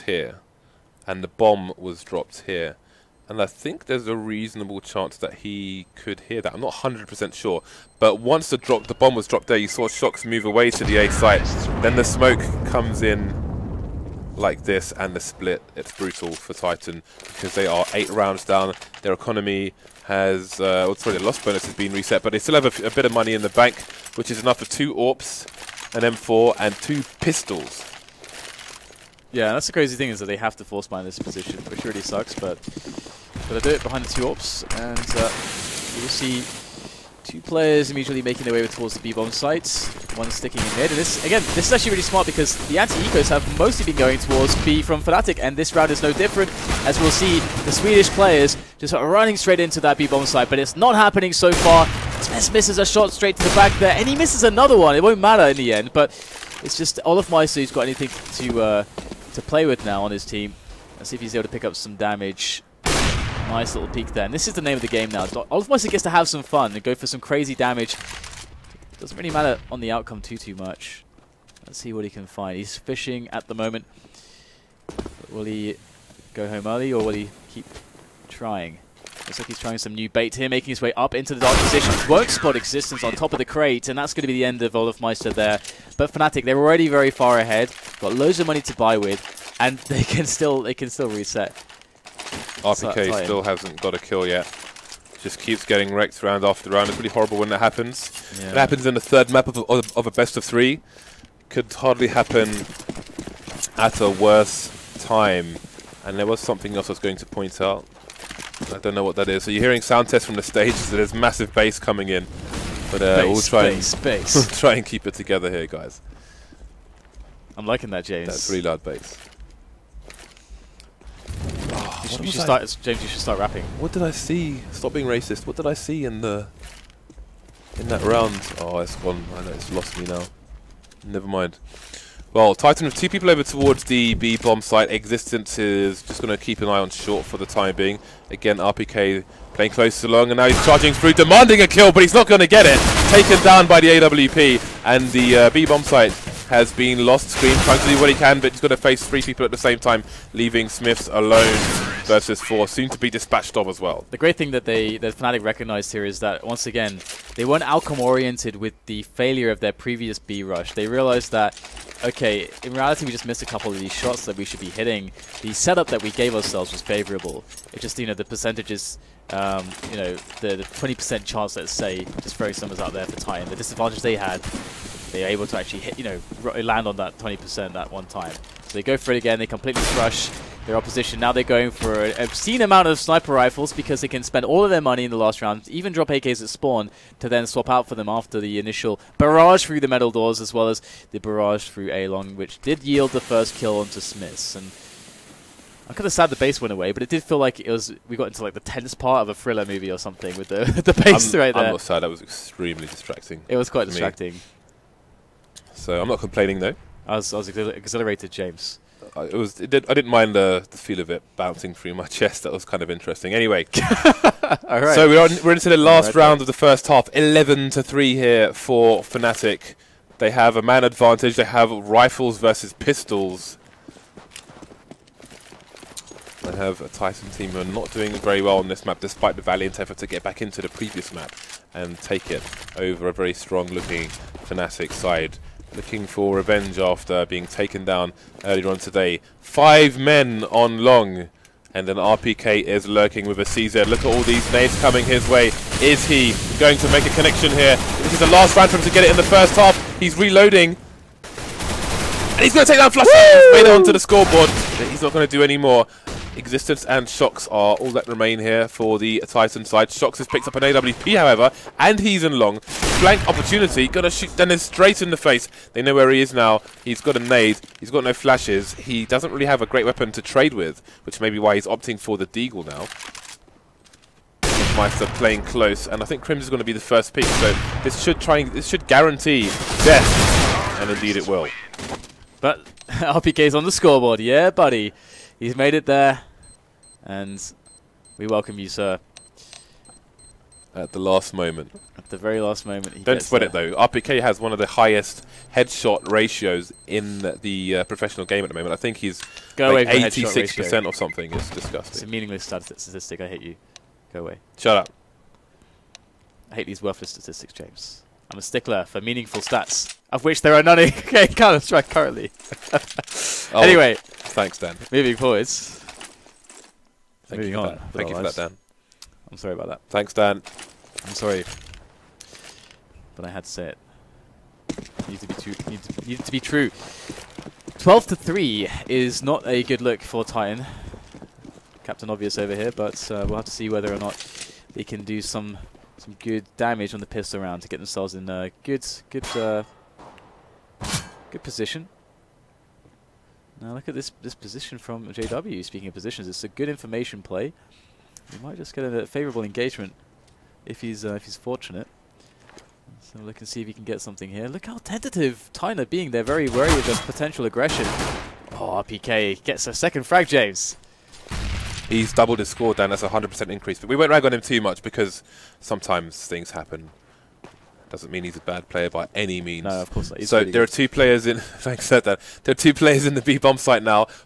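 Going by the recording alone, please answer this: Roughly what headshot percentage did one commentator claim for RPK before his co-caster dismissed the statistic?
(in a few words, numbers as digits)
86%.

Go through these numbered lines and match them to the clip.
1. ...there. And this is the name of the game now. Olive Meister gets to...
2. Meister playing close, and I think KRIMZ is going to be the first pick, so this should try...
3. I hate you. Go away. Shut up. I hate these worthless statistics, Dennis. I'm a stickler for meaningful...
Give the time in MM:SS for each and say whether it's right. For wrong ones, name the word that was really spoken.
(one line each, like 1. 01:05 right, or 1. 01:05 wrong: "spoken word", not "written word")
1. 01:04 wrong: "Moisey", not "Meister"
2. 04:34 right
3. 05:03 wrong: "James", not "Dennis".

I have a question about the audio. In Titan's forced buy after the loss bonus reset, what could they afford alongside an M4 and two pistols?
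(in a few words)
two AWPs.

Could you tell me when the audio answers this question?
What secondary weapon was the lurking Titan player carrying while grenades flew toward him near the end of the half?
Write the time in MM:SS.
04:03.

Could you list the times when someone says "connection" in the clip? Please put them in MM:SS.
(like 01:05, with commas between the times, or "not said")
04:07.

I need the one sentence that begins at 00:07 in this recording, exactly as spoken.
But once the drop, the bomb was dropped there, you saw shox move away to the A site.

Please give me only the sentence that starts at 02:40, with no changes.
They realized that, okay, in reality, we just missed a couple of these shots that we should be hitting.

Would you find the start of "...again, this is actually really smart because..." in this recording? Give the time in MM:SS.
00:41.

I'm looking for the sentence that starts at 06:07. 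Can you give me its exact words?
Doesn't mean he's a bad player by any means.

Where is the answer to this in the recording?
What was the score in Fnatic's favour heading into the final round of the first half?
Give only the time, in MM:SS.
03:37.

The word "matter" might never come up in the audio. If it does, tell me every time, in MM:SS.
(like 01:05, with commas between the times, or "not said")
00:55, 01:09.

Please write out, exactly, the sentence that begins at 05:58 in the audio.
Oh, PK gets a second frag, James.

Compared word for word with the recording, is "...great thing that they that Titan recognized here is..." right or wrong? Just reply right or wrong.
wrong.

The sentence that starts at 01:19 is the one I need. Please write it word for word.
Looks like he's trying some new bait here, making his way up into the dark position.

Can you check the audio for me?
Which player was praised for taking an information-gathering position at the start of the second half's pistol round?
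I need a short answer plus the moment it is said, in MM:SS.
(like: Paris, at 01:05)
JW, at 05:45.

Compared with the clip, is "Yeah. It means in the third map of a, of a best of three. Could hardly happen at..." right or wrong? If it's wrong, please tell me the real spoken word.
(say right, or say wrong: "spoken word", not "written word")
wrong: "happens", not "means".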